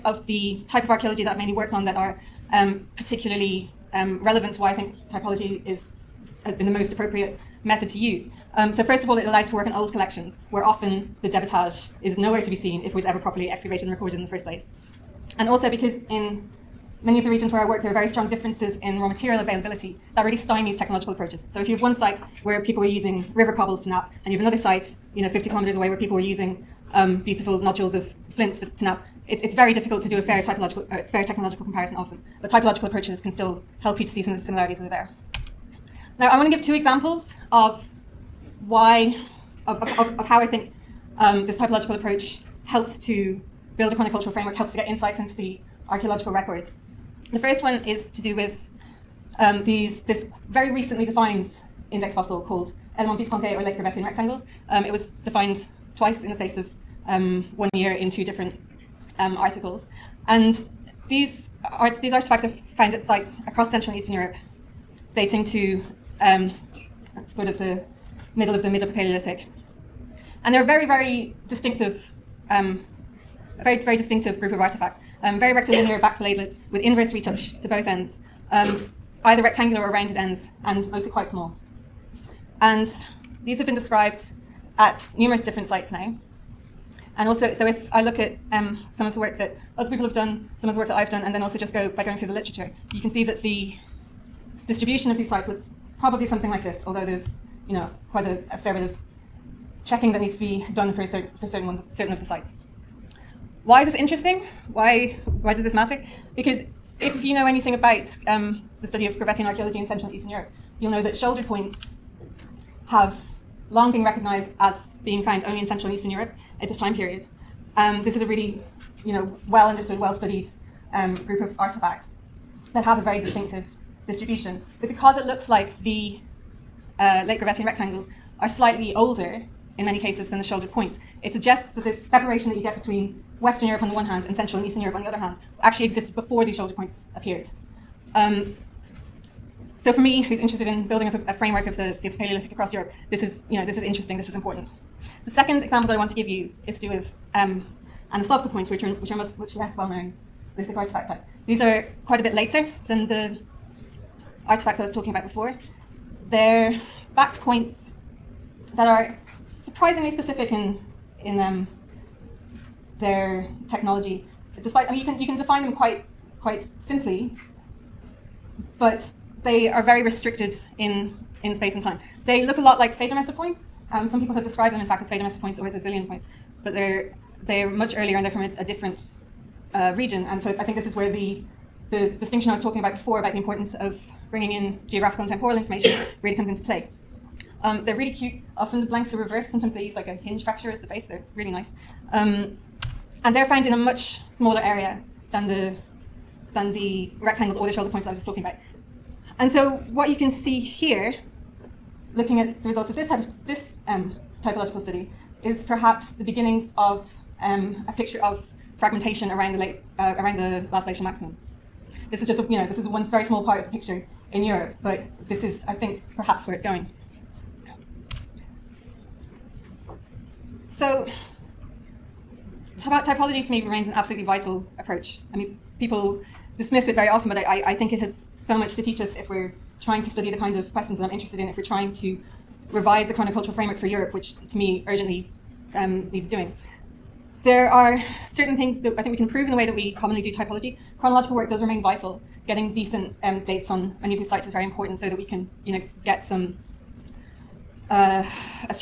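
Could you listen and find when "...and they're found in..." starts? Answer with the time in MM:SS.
03:13.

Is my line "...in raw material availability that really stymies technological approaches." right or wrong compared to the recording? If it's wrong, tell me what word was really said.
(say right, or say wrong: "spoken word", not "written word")
right.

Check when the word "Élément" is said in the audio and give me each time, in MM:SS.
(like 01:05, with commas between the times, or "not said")
00:52.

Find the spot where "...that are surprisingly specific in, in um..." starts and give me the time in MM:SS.
02:38.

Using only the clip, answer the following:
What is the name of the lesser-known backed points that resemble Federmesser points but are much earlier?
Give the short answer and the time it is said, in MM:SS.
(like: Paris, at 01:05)
Slavka points, at 02:28.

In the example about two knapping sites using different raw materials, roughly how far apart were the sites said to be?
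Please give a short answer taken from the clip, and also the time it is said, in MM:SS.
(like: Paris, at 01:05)
50 kilometers, at 00:25.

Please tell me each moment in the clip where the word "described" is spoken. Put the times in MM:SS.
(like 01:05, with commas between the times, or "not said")
01:23, 02:54.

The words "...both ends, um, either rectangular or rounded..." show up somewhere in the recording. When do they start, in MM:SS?
01:17.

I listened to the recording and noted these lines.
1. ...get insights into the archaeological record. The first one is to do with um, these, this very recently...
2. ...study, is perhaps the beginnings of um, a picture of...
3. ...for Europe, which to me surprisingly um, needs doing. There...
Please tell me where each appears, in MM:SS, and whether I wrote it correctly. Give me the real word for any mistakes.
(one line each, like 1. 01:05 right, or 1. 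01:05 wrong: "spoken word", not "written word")
1. 00:44 right
2. 03:24 right
3. 03:53 wrong: "urgently", not "surprisingly".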